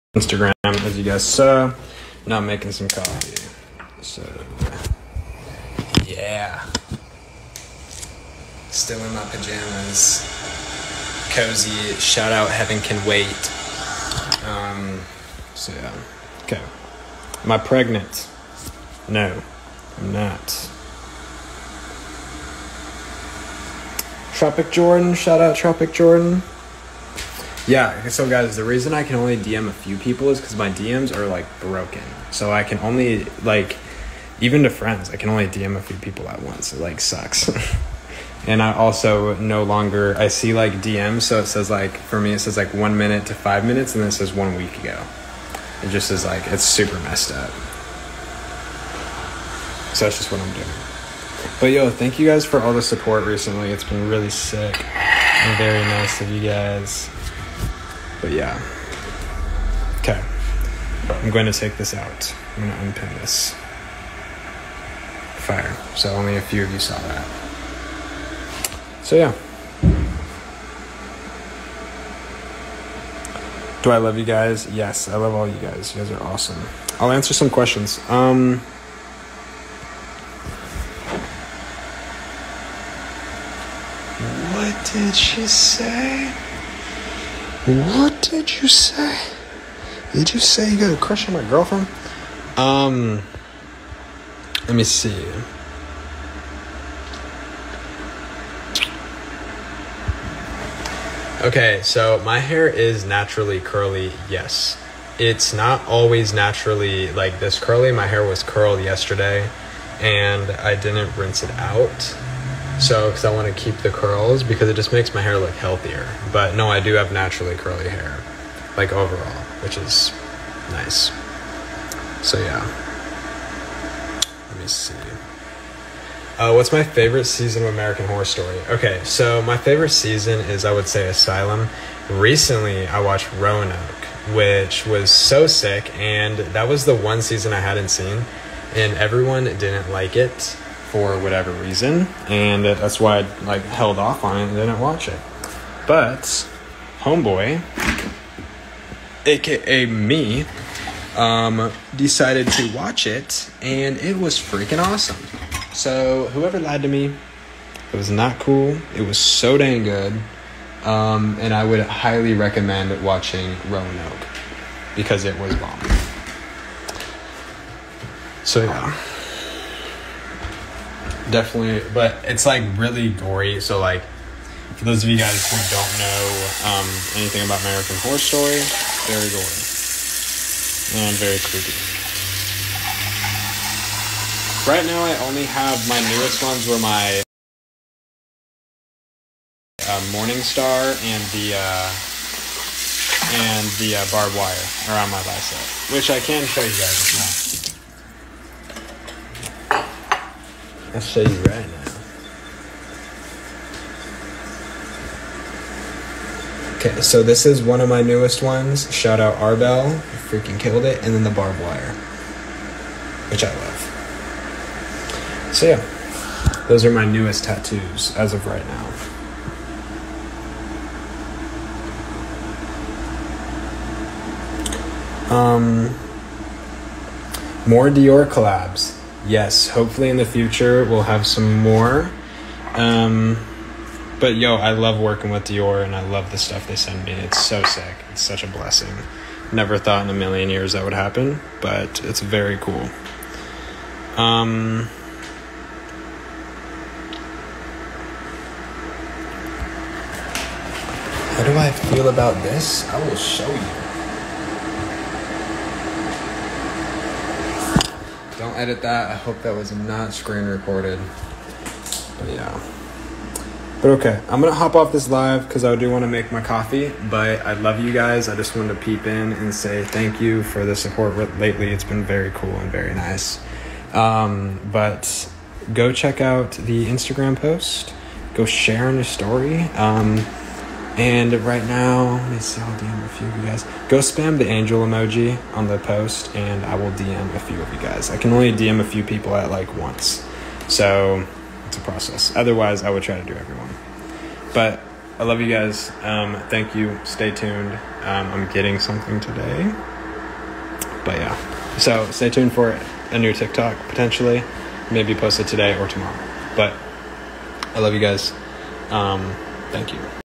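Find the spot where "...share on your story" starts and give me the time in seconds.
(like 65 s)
278 s.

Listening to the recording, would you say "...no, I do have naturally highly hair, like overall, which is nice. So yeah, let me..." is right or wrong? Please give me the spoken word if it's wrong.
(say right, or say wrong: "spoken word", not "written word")
wrong: "curly", not "highly".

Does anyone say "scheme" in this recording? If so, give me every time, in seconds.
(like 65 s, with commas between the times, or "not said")
not said.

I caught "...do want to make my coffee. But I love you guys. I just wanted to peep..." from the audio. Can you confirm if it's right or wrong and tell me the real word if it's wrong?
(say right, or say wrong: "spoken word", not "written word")
right.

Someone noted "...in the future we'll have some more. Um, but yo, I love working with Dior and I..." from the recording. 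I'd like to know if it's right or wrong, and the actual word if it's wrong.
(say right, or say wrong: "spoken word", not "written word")
right.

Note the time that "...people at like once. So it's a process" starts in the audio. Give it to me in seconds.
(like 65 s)
289 s.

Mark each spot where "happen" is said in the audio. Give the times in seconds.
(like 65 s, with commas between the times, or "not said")
240 s.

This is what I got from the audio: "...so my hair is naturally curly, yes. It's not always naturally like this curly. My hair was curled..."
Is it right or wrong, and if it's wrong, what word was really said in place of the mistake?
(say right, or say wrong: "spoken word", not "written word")
right.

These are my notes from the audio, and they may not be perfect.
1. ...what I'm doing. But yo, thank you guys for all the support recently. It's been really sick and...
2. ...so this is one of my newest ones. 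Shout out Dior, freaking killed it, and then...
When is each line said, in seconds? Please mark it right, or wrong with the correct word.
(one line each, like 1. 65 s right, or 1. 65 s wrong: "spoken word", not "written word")
1. 50 s right
2. 207 s wrong: "Arbel", not "Dior".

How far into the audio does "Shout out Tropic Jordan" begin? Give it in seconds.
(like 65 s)
25 s.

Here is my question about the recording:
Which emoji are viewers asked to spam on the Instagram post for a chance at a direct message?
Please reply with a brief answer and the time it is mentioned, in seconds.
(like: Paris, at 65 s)
Angel emoji, at 284 s.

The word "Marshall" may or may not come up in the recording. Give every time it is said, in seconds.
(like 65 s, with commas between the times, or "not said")
not said.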